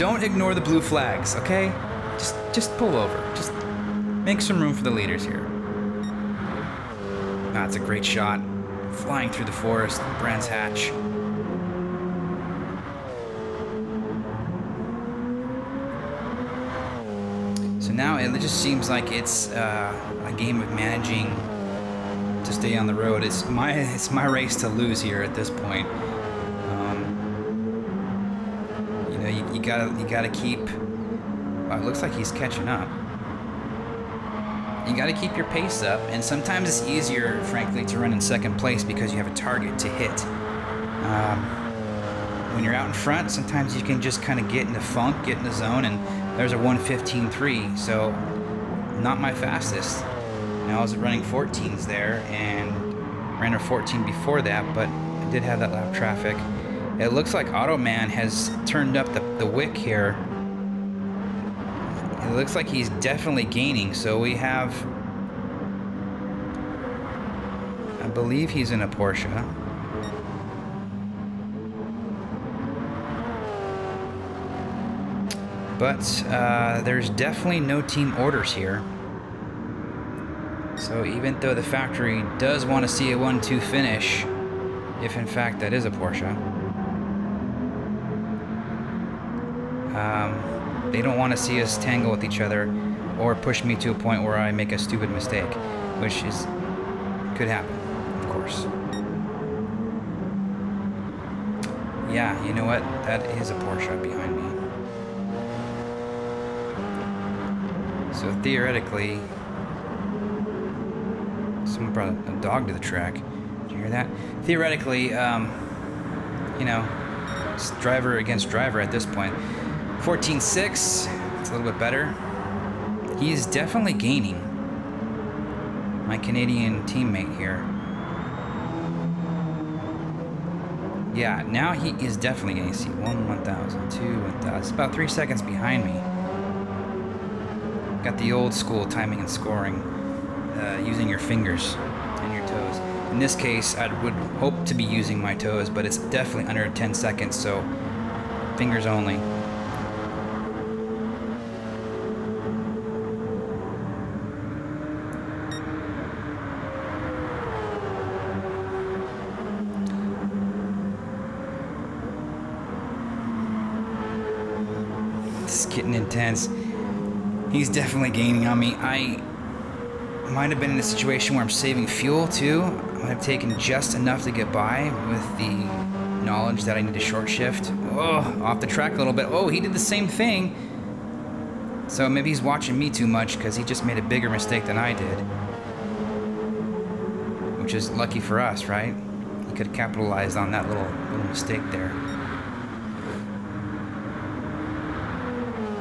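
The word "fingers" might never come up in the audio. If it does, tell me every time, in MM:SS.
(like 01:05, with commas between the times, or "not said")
02:21, 02:28.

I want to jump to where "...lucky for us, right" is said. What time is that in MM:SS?
03:07.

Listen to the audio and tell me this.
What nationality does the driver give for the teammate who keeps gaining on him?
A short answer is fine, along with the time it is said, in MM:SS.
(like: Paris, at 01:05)
Canadian, at 02:06.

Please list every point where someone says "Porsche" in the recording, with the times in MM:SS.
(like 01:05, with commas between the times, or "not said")
01:08, 01:25, 01:43.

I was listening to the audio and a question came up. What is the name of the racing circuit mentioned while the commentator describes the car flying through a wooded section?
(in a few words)
Brands Hatch.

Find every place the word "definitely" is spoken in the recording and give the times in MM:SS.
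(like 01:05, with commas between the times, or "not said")
01:02, 01:17, 02:03, 02:12, 02:25, 02:47.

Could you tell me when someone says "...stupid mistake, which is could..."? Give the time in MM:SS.
01:34.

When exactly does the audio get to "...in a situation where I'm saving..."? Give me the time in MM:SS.
02:50.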